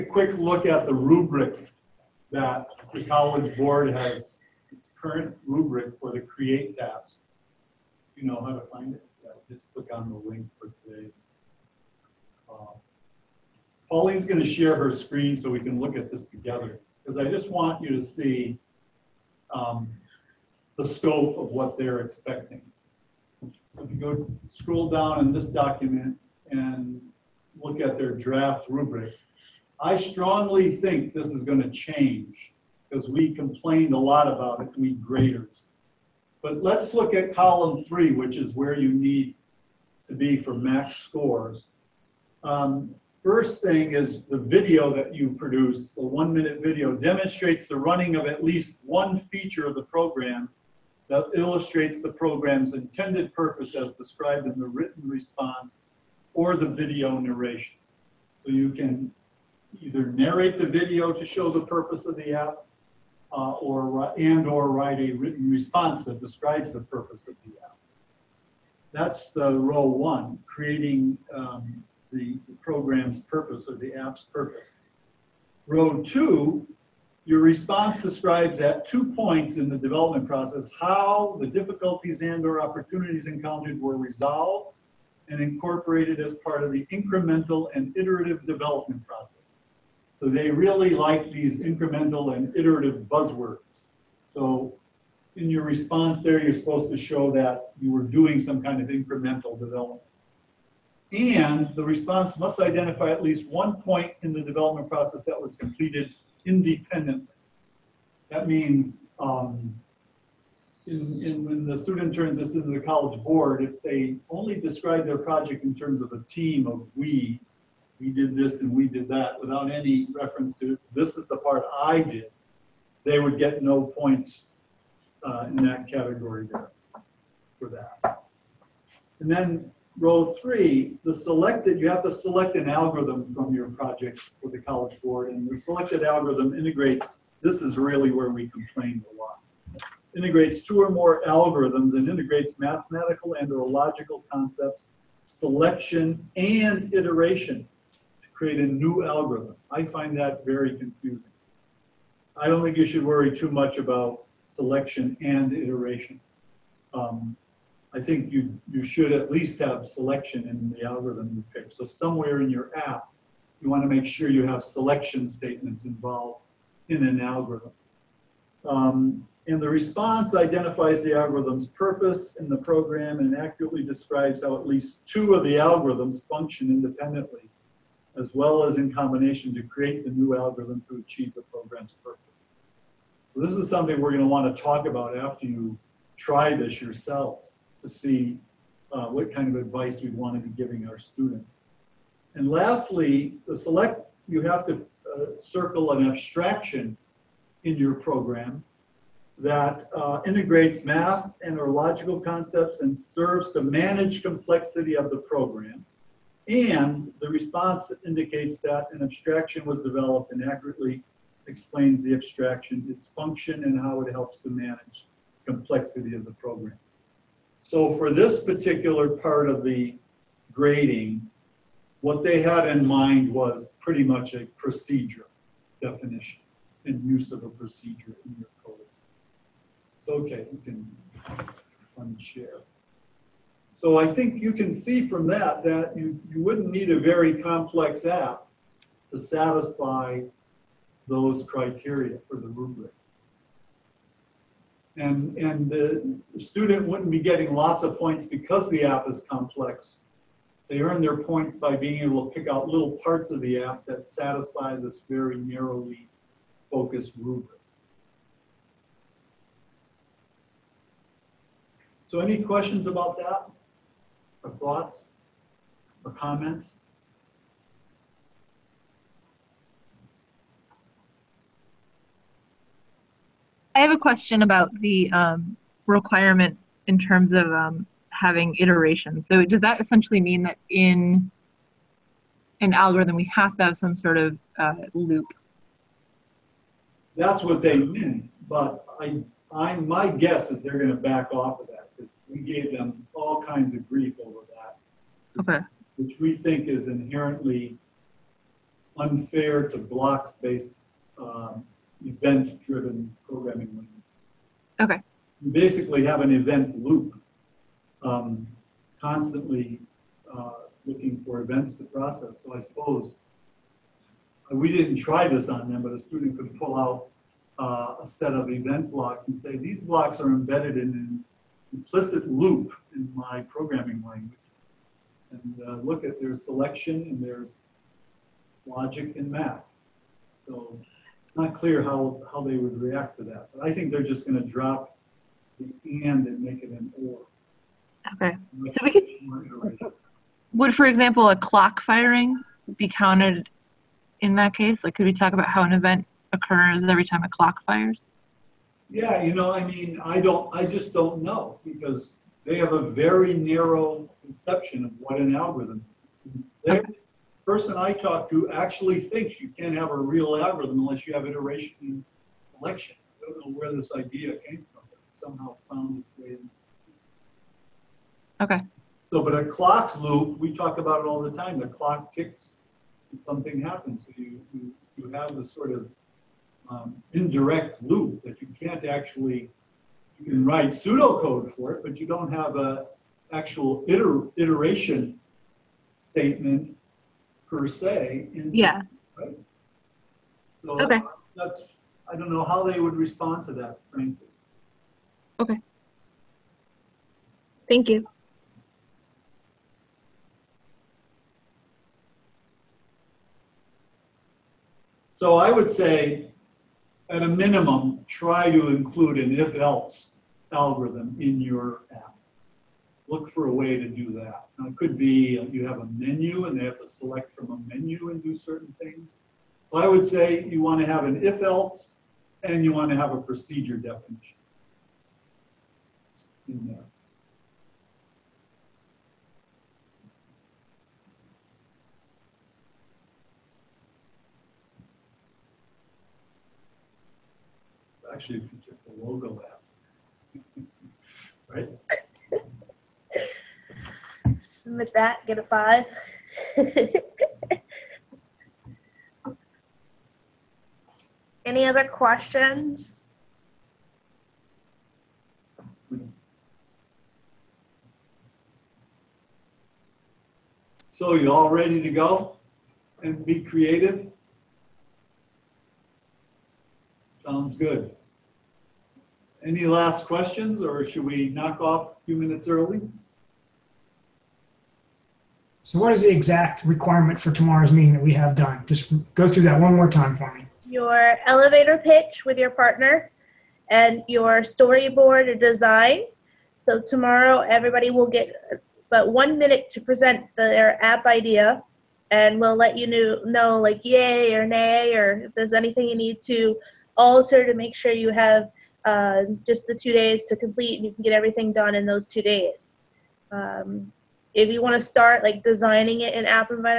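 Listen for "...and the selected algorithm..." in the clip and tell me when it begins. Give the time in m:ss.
2:15.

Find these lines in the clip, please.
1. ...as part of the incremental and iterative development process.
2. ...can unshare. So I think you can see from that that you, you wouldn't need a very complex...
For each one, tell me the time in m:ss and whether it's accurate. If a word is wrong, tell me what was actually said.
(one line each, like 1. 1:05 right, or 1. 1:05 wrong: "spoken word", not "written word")
1. 1:26 right
2. 3:50 right.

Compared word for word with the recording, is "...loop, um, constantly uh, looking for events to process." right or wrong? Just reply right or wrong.
right.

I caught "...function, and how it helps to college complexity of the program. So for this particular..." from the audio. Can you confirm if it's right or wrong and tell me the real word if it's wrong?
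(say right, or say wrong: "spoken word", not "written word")
wrong: "manage", not "college".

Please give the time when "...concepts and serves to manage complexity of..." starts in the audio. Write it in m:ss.
3:22.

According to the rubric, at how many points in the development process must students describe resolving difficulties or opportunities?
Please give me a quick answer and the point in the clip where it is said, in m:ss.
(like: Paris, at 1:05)
2, at 1:18.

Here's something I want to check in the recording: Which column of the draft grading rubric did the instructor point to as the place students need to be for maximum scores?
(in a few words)
3.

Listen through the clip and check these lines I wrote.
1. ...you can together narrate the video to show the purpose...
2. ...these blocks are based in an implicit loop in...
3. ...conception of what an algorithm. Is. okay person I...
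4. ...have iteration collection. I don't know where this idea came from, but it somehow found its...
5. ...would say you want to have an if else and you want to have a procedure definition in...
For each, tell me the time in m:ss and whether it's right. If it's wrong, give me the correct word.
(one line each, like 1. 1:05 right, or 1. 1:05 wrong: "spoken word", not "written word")
1. 0:58 wrong: "either", not "together"
2. 5:19 wrong: "embedded", not "based"
3. 5:54 right
4. 6:01 right
5. 6:59 right.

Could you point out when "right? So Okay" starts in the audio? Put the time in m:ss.
6:29.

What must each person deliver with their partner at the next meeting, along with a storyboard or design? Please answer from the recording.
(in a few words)
elevator pitch.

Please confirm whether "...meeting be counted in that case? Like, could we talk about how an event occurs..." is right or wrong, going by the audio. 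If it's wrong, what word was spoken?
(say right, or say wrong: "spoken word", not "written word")
wrong: "firing", not "meeting".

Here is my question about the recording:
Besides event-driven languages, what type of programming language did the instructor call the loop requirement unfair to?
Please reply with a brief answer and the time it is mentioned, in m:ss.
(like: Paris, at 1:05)
block based, at 4:59.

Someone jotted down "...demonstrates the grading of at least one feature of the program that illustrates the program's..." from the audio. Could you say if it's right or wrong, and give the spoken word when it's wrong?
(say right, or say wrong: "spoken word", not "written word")
wrong: "running", not "grading".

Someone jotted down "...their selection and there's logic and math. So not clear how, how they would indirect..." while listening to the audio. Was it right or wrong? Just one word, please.
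wrong.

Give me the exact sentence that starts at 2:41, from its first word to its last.
So somewhere in your app, you want to make sure you have selection statements involved in an algorithm.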